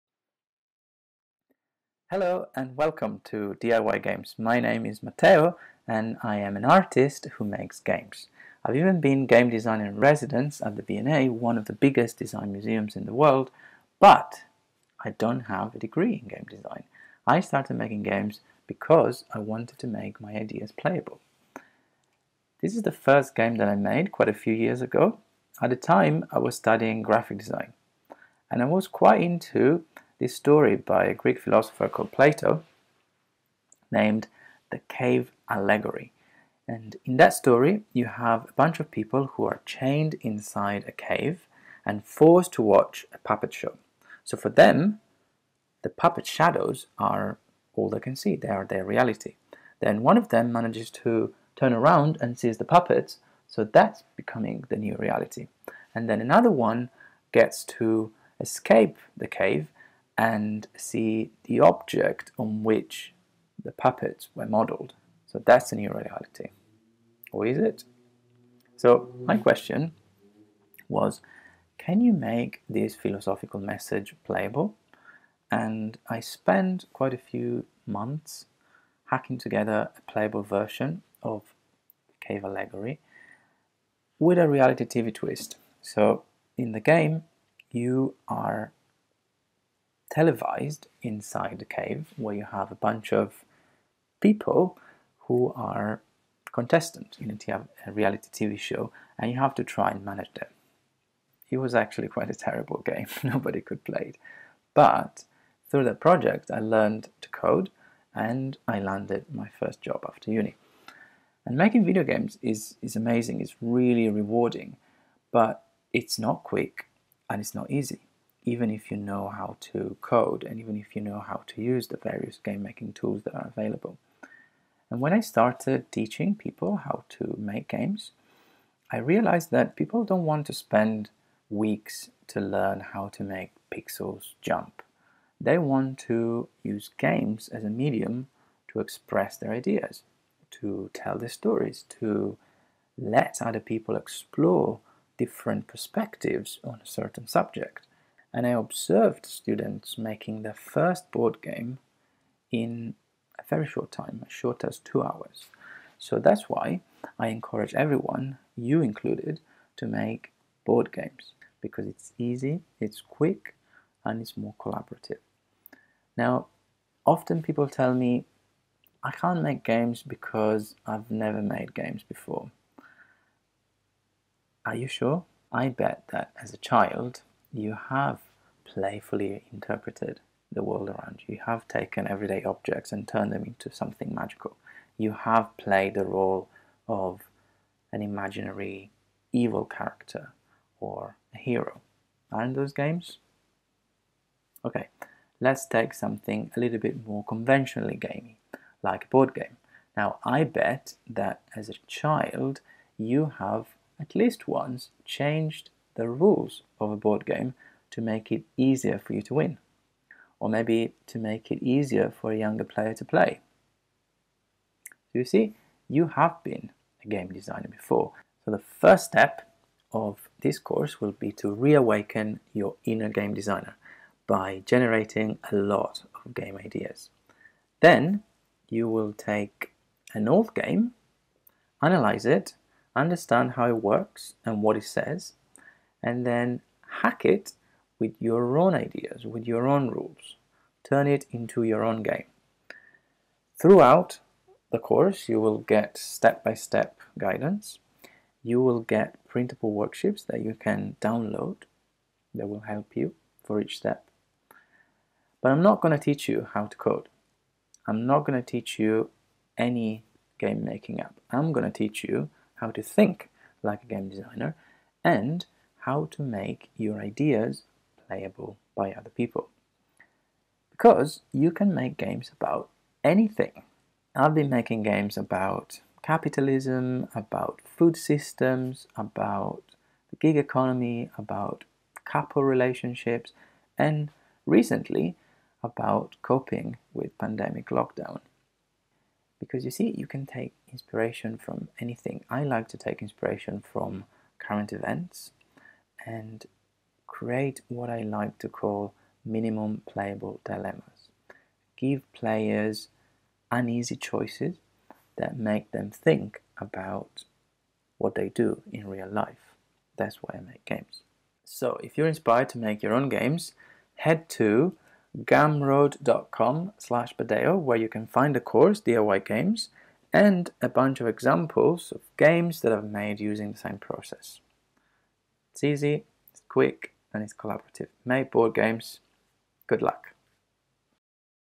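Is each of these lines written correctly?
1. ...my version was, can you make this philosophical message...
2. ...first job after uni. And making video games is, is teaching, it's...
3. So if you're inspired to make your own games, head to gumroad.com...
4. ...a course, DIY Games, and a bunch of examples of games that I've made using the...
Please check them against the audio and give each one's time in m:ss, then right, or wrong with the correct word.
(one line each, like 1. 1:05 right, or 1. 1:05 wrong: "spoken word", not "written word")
1. 1:09 wrong: "question", not "version"
2. 1:49 wrong: "amazing", not "teaching"
3. 5:11 right
4. 5:18 right.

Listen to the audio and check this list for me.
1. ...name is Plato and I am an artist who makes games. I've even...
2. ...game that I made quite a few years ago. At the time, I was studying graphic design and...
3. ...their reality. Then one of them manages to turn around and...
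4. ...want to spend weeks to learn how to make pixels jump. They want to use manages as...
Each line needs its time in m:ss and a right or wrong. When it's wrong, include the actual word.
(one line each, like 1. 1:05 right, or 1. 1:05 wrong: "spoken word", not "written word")
1. 0:04 wrong: "Matteo", not "Plato"
2. 0:23 right
3. 0:48 right
4. 2:10 wrong: "games", not "manages".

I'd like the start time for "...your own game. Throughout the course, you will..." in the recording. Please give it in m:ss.
4:01.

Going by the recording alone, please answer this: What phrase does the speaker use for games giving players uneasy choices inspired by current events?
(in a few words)
Minimum playable dilemmas.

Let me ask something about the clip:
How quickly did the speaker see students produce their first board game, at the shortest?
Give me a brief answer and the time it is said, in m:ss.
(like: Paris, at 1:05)
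2 hours, at 2:34.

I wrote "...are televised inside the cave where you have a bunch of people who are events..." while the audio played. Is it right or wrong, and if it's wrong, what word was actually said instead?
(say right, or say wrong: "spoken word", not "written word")
wrong: "contestants", not "events".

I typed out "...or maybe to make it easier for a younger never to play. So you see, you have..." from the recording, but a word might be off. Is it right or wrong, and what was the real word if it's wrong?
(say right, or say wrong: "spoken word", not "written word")
wrong: "player", not "never".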